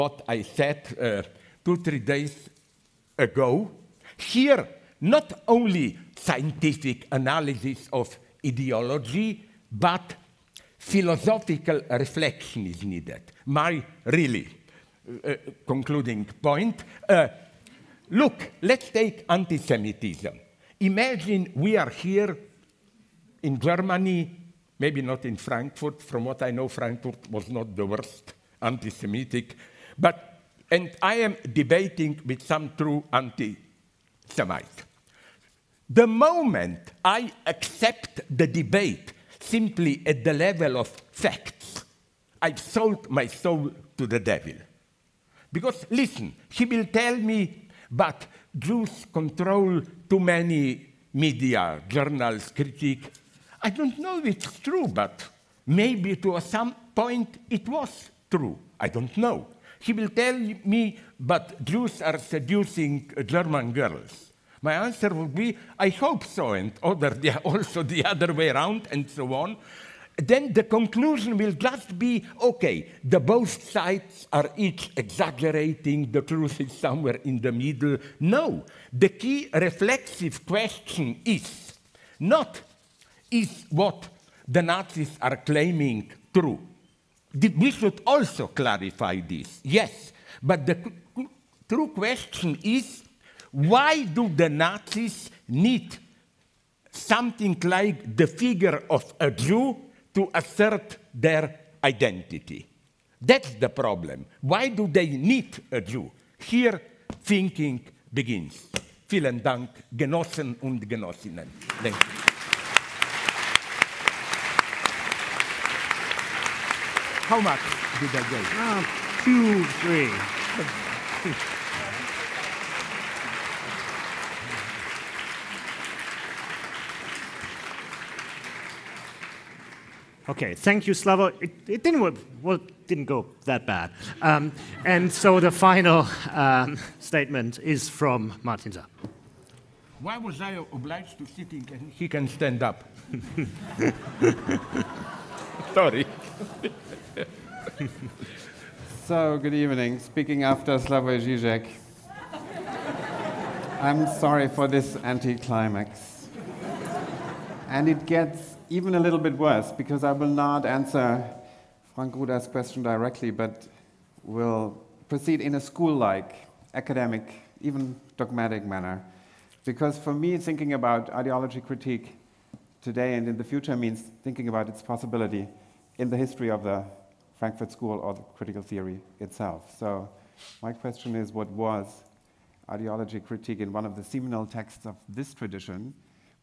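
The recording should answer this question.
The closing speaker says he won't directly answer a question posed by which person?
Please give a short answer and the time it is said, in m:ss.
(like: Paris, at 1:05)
Frank Ruda, at 2:41.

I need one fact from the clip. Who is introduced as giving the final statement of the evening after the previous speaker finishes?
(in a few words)
Martin Saar.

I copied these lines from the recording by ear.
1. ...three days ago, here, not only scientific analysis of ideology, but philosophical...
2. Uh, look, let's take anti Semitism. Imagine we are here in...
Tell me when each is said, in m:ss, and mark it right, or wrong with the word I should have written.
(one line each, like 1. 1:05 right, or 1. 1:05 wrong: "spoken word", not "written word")
1. 0:01 right
2. 0:17 right.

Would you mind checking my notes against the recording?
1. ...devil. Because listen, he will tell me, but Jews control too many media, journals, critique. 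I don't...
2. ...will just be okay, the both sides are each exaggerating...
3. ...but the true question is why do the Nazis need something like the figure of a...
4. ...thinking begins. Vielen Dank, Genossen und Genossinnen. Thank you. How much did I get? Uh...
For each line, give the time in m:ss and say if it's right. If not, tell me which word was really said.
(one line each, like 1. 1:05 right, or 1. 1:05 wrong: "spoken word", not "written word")
1. 0:44 right
2. 1:11 right
3. 1:30 right
4. 1:47 right.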